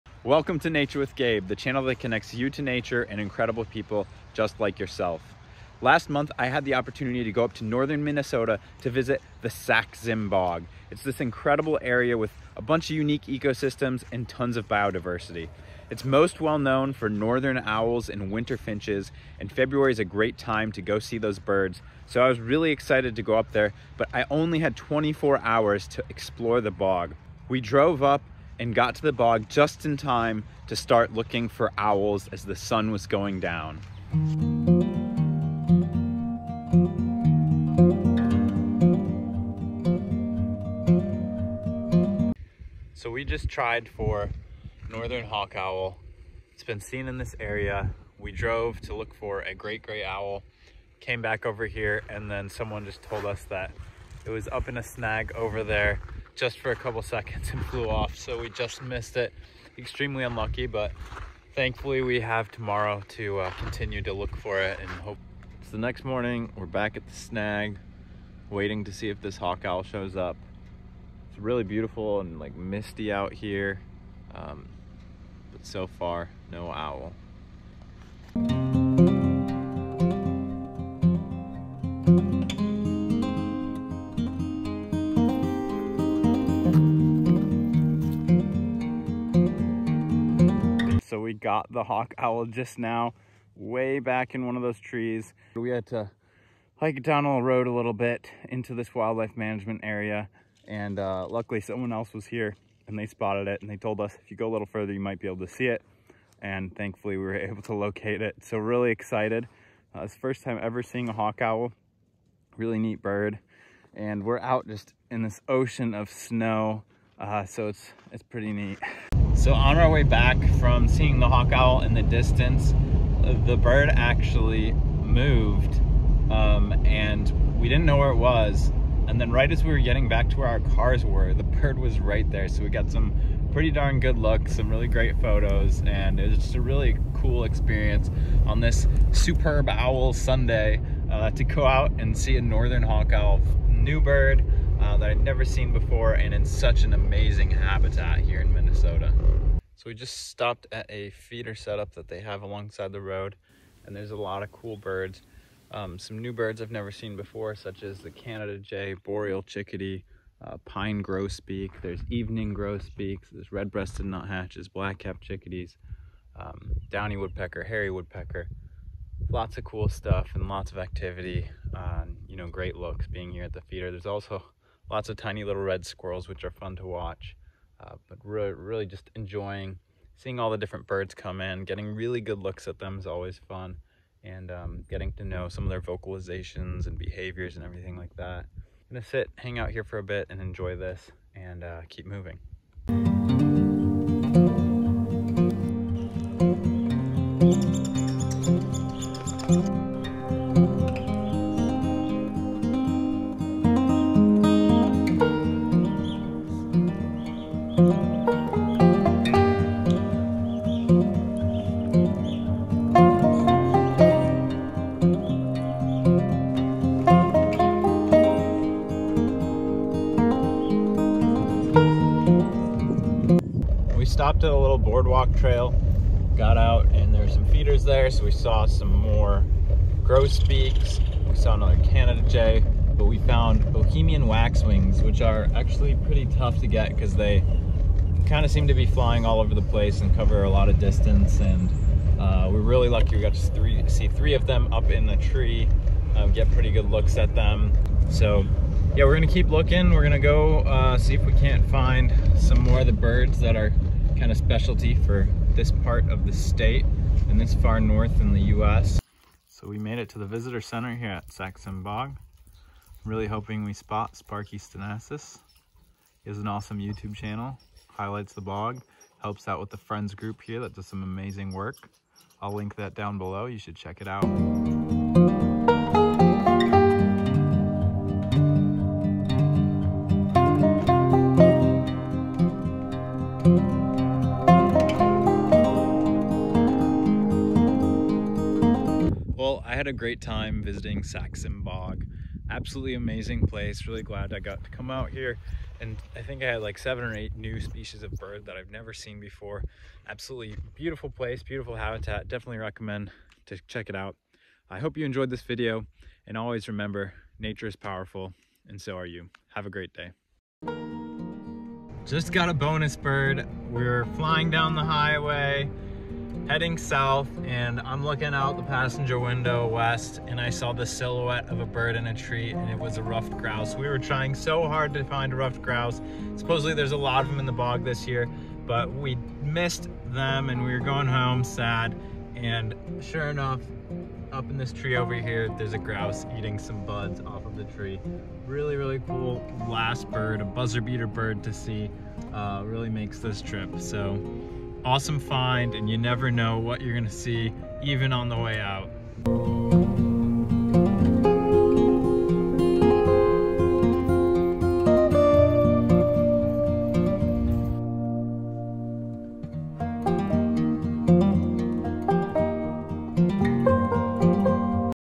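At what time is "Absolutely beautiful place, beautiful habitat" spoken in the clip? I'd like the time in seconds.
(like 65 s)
300 s.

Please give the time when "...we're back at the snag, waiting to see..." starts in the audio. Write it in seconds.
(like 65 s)
66 s.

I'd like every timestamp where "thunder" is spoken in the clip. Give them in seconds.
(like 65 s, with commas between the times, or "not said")
not said.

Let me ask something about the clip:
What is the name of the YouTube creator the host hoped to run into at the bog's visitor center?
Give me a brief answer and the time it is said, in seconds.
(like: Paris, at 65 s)
Sparky Stensaas, at 264 s.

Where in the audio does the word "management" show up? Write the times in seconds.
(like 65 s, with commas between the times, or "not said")
99 s.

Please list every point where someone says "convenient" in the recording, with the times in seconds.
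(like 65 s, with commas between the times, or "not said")
not said.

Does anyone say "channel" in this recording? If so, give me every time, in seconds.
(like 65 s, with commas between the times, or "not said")
1 s, 267 s.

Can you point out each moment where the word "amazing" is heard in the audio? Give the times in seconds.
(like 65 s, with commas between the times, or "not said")
146 s, 271 s, 292 s.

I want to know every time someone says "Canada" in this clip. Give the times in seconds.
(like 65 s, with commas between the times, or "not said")
158 s, 231 s.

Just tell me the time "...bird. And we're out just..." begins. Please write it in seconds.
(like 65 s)
113 s.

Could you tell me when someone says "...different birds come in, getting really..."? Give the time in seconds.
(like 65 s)
180 s.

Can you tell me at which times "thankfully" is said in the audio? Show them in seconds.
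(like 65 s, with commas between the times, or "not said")
61 s, 106 s.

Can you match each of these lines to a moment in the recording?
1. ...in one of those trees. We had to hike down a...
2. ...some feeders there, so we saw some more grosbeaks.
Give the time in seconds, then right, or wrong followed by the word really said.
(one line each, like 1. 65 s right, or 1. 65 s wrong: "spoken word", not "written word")
1. 94 s right
2. 227 s right.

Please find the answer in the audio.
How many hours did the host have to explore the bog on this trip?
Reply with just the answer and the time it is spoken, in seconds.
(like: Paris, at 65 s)
24, at 24 s.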